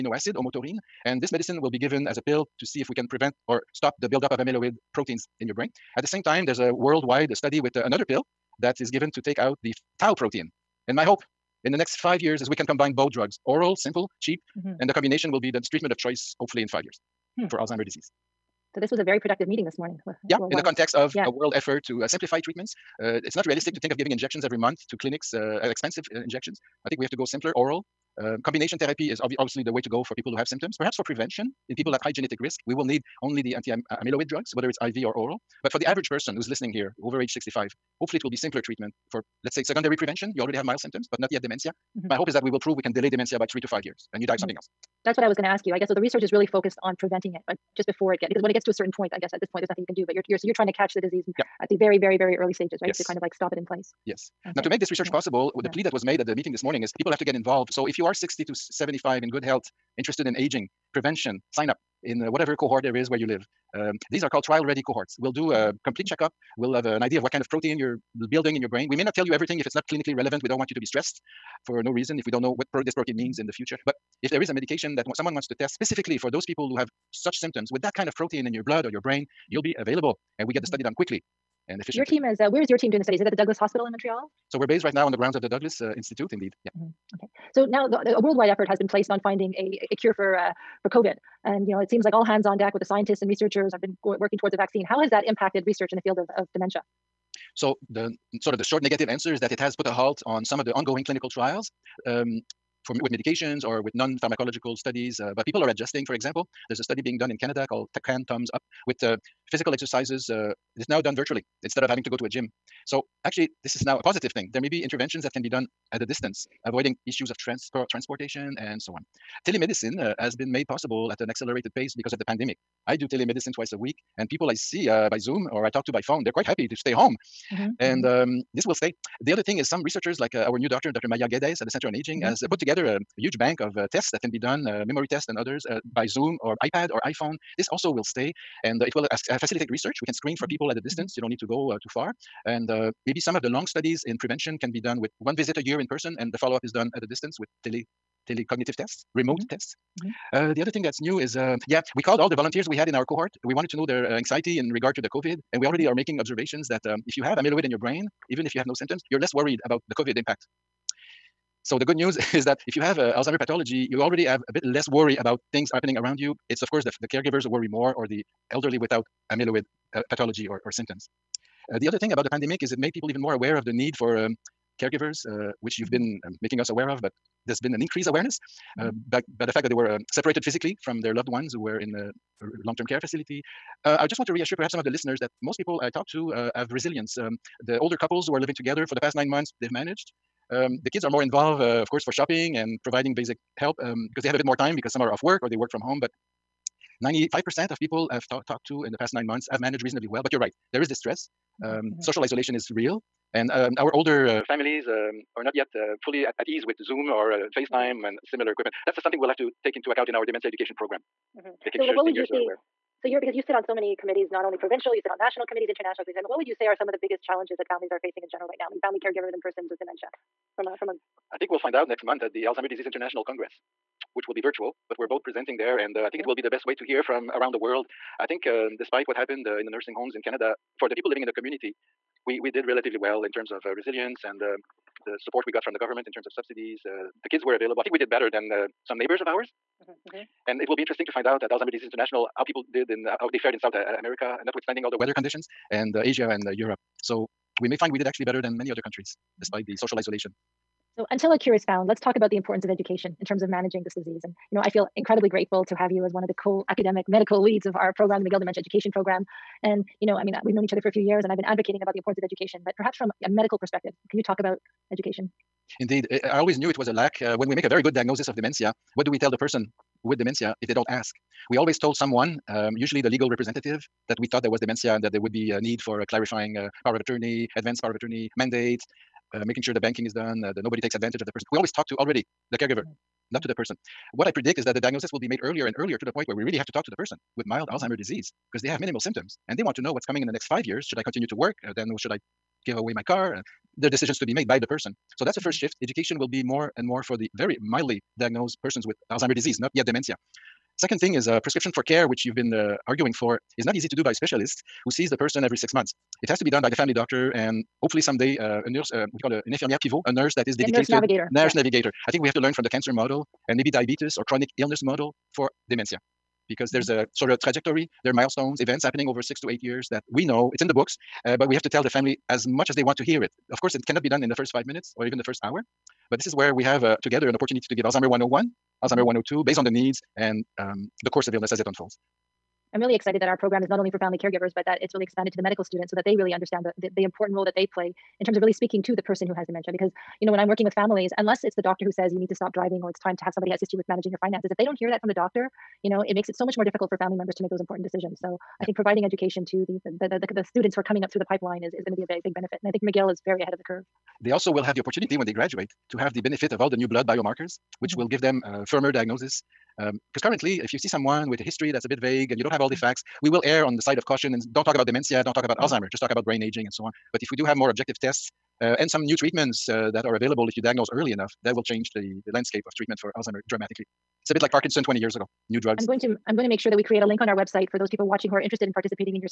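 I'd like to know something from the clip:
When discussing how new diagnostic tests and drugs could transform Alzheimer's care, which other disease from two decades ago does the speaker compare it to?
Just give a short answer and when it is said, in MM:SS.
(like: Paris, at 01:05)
Parkinson, at 06:14.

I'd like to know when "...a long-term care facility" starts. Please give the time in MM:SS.
03:02.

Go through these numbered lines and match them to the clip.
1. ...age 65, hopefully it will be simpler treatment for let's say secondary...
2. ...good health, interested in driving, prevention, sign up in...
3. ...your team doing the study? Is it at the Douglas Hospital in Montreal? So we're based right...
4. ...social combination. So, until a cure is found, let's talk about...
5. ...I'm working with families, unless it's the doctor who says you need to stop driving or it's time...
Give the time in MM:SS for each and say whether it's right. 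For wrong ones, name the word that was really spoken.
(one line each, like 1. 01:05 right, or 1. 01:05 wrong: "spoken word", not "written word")
1. 00:37 right
2. 00:59 wrong: "aging", not "driving"
3. 01:22 right
4. 04:09 wrong: "isolation", not "combination"
5. 05:40 right.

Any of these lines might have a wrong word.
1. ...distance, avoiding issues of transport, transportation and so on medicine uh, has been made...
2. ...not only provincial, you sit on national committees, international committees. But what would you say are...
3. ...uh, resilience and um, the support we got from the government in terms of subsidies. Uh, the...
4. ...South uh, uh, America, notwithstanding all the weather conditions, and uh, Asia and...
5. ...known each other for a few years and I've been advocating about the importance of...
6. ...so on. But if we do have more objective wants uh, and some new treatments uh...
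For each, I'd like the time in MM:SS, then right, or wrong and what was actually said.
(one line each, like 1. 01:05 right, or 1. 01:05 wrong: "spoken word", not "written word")
1. 01:56 wrong: "telemedicine", not "medicine"
2. 03:34 right
3. 03:53 right
4. 04:03 right
5. 04:20 right
6. 06:06 wrong: "tests", not "wants".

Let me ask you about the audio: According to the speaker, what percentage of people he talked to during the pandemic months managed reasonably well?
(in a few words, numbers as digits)
95%.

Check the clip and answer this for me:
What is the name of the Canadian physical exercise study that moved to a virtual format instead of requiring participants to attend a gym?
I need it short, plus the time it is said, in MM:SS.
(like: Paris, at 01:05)
Can Thumbs Up, at 01:48.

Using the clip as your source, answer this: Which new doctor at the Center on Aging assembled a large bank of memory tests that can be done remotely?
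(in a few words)
Dr. Maiya Geddes.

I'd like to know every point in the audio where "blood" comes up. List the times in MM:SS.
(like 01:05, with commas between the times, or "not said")
01:18, 05:56.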